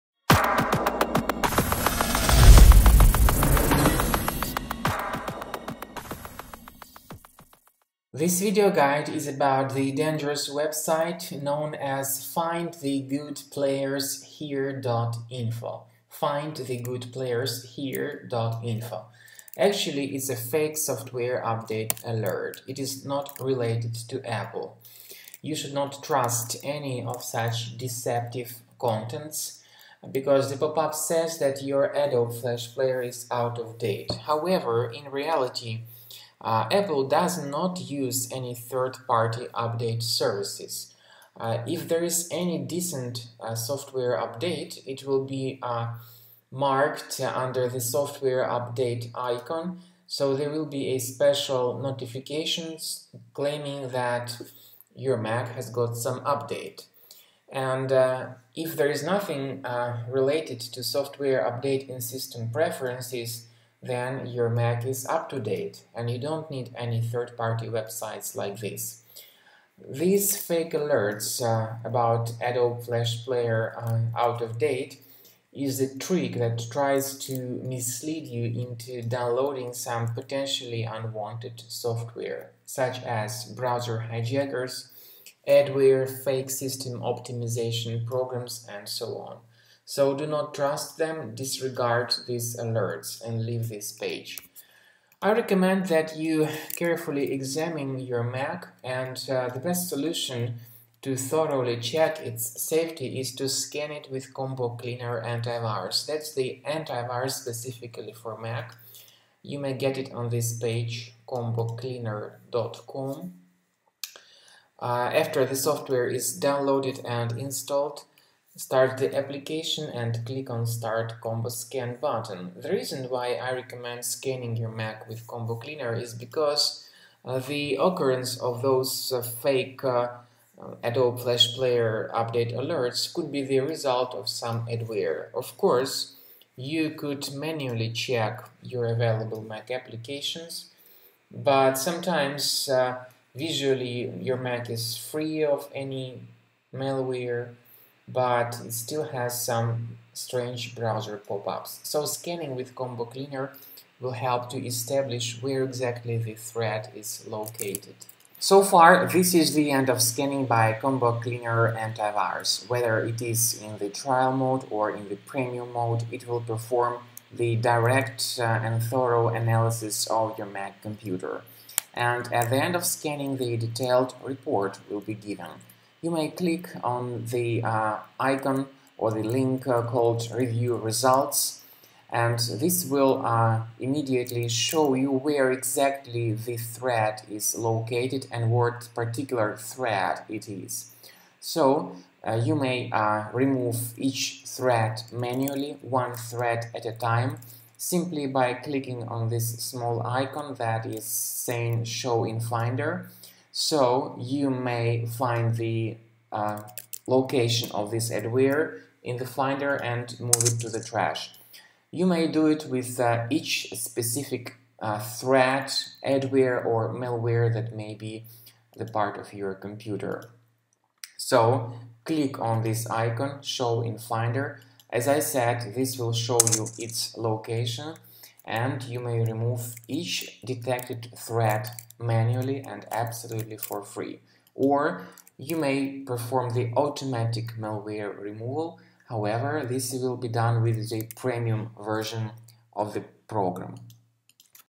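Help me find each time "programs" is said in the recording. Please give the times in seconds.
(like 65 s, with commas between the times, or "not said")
88 s, 243 s.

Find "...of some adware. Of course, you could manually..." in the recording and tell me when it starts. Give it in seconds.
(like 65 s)
134 s.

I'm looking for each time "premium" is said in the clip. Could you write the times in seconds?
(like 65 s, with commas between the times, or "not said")
165 s, 241 s.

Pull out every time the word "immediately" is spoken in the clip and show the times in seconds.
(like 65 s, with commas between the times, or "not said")
183 s.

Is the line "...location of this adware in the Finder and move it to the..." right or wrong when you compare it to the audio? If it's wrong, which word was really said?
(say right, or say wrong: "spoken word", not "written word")
right.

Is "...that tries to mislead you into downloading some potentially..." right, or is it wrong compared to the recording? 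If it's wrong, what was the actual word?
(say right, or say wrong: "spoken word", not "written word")
right.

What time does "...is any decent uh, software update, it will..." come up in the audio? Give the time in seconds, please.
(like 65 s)
42 s.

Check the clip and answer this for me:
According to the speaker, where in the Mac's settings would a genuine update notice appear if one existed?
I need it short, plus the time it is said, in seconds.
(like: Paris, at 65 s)
System Preferences, at 62 s.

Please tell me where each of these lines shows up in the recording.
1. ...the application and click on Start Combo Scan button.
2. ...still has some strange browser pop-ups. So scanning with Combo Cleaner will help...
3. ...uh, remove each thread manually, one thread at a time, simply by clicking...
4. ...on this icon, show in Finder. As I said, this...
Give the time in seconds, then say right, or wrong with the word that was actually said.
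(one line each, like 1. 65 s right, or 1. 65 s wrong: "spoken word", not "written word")
1. 118 s right
2. 148 s right
3. 192 s right
4. 222 s right.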